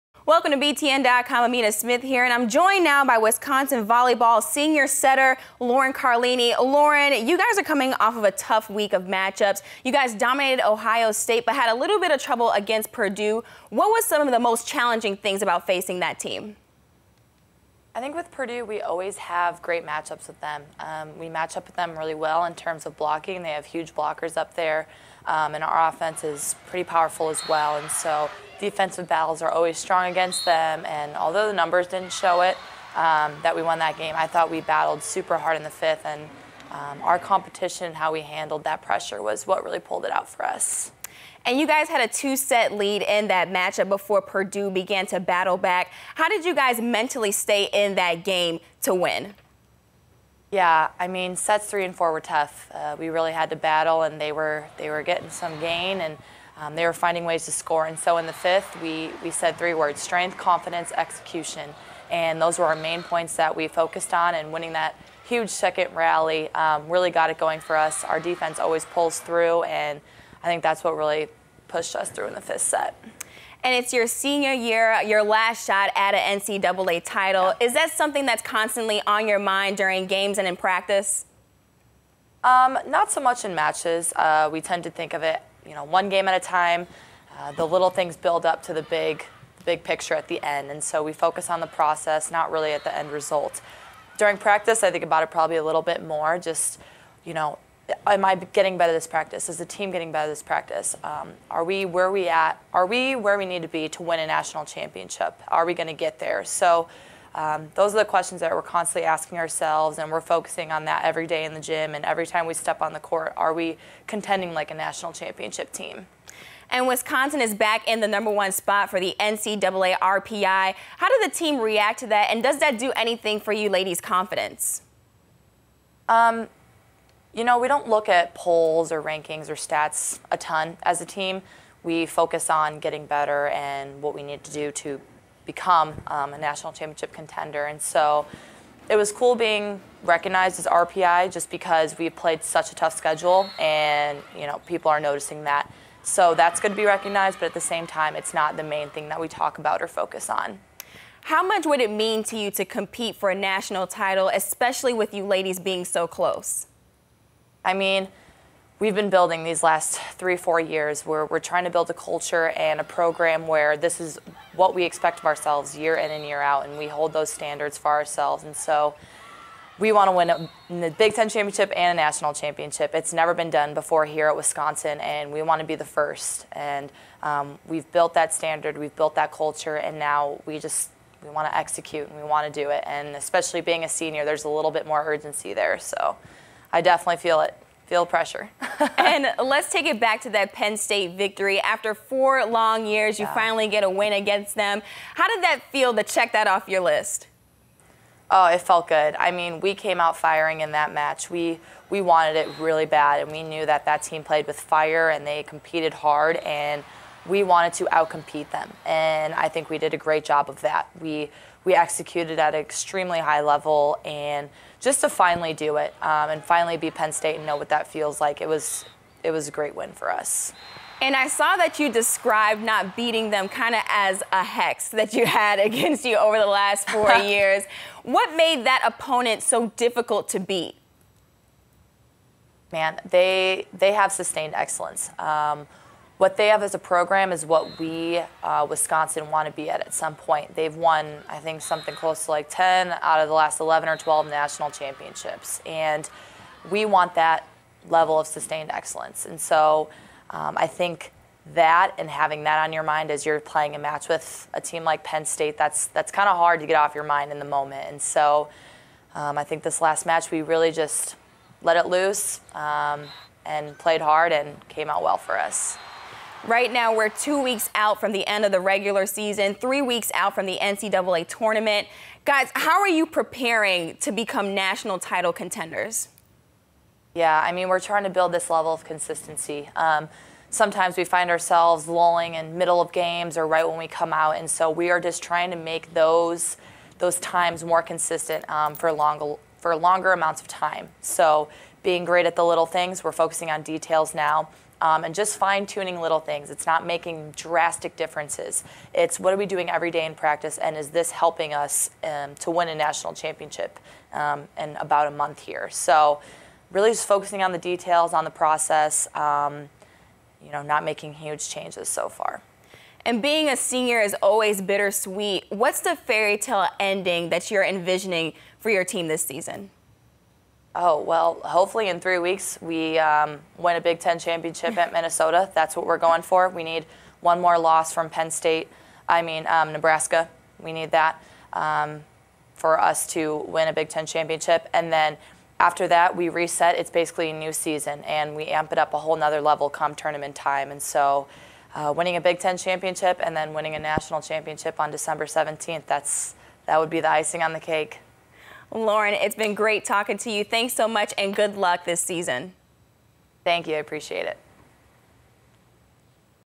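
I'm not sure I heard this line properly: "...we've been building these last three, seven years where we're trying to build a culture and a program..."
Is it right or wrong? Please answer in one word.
wrong.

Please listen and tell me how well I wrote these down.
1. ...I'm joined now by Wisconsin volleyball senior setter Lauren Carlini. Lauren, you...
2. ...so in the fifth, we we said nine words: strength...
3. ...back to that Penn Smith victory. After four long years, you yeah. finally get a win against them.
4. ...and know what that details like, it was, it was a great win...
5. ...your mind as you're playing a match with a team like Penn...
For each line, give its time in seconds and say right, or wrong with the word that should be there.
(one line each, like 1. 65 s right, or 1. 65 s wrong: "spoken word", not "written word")
1. 2 s right
2. 57 s wrong: "three", not "nine"
3. 189 s wrong: "State", not "Smith"
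4. 217 s wrong: "feels", not "details"
5. 252 s right.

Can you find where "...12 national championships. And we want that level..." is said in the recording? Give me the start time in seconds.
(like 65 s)
243 s.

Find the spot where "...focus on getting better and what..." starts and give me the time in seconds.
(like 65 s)
132 s.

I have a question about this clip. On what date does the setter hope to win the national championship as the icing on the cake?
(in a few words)
December 17.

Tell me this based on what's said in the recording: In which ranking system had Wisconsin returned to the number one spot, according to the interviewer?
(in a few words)
NCAA RPI.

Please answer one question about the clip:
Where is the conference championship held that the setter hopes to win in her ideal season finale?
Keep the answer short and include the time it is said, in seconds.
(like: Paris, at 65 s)
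Minnesota, at 324 s.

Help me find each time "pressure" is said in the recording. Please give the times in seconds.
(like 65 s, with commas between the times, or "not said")
38 s, 188 s.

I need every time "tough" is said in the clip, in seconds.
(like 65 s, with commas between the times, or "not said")
8 s, 52 s, 142 s.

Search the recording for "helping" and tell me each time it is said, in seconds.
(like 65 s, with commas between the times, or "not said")
301 s.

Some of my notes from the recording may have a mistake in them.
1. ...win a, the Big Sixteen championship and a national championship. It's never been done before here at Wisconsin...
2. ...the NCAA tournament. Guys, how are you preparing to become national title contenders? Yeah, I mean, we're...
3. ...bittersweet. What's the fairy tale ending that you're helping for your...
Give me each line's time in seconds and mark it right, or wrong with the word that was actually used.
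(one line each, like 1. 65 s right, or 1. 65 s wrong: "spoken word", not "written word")
1. 170 s wrong: "Ten", not "Sixteen"
2. 270 s right
3. 314 s wrong: "envisioning", not "helping".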